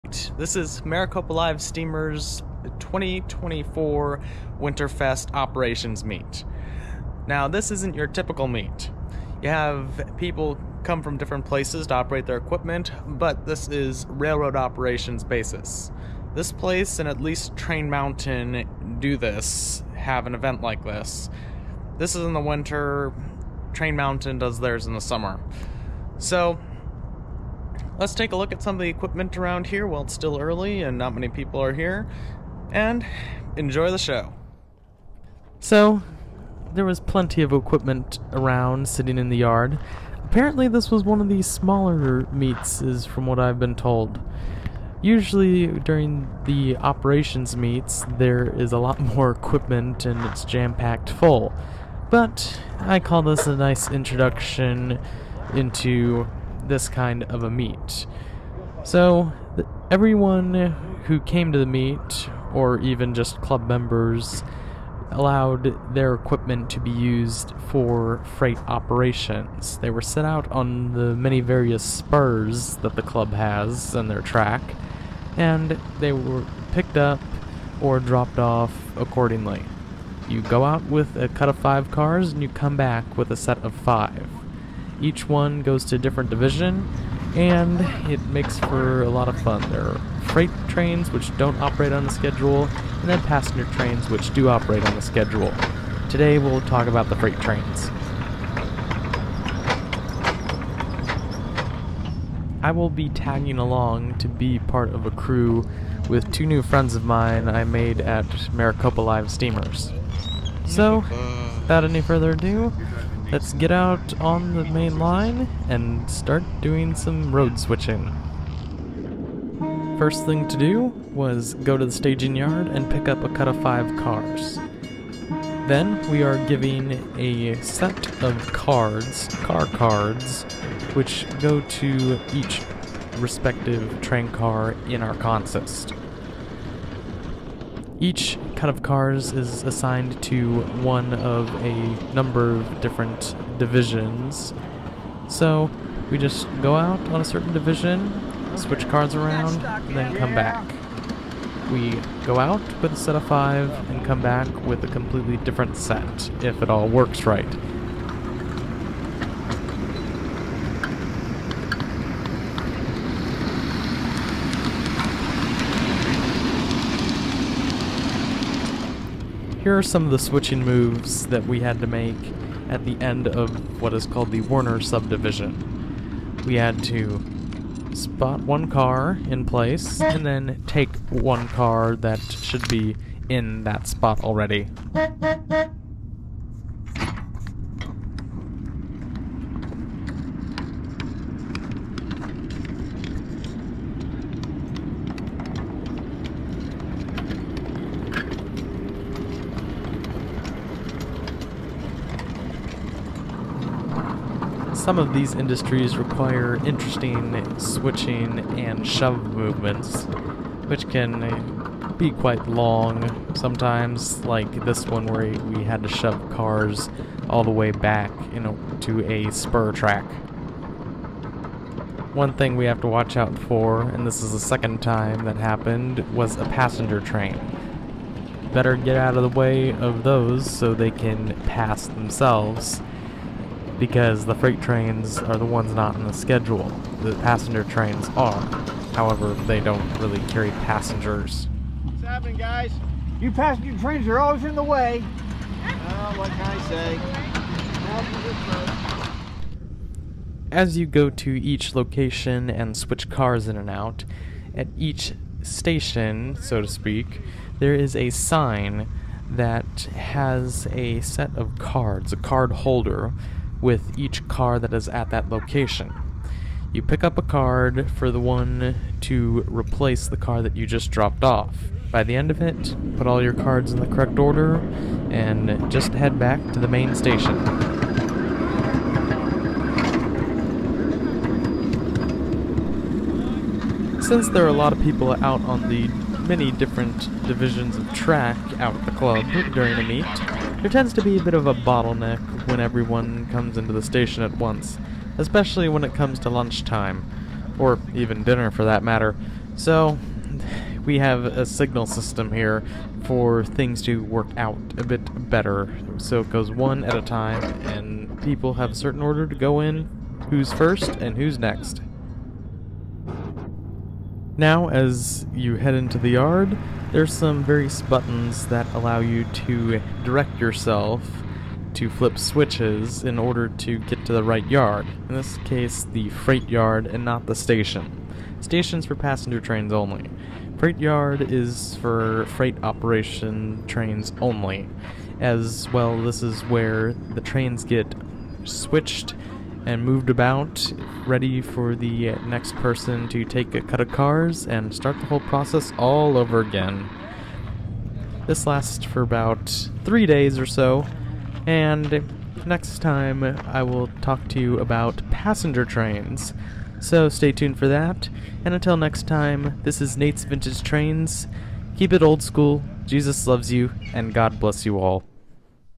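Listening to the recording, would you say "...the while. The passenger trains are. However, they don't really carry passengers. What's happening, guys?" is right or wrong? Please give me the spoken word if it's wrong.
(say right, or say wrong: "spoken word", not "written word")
wrong: "schedule", not "while".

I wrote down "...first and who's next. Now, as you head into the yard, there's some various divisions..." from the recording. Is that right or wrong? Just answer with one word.
wrong.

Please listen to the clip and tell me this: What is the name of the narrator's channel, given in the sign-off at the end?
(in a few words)
Nate's Vintage Trains.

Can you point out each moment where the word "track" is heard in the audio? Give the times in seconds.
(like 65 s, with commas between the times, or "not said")
74 s, 219 s, 287 s.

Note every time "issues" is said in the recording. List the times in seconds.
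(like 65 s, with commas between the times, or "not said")
not said.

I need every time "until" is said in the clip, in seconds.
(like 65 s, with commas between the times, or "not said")
358 s.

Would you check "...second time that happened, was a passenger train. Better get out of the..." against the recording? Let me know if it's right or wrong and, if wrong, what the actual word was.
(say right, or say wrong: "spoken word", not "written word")
right.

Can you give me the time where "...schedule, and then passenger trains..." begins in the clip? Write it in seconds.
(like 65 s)
92 s.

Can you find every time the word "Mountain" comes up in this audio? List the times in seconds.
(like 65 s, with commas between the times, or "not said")
17 s, 23 s.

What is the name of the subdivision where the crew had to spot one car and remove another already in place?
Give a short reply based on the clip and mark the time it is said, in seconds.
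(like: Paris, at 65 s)
Warner subdivision, at 174 s.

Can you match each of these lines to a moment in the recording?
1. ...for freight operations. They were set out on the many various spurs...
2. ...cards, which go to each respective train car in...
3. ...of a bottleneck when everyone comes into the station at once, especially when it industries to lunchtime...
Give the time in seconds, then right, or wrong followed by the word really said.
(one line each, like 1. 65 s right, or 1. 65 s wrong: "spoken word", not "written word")
1. 67 s right
2. 129 s right
3. 291 s wrong: "comes", not "industries".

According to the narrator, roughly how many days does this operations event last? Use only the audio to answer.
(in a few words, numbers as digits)
3.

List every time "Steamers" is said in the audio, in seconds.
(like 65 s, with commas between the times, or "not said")
1 s, 109 s.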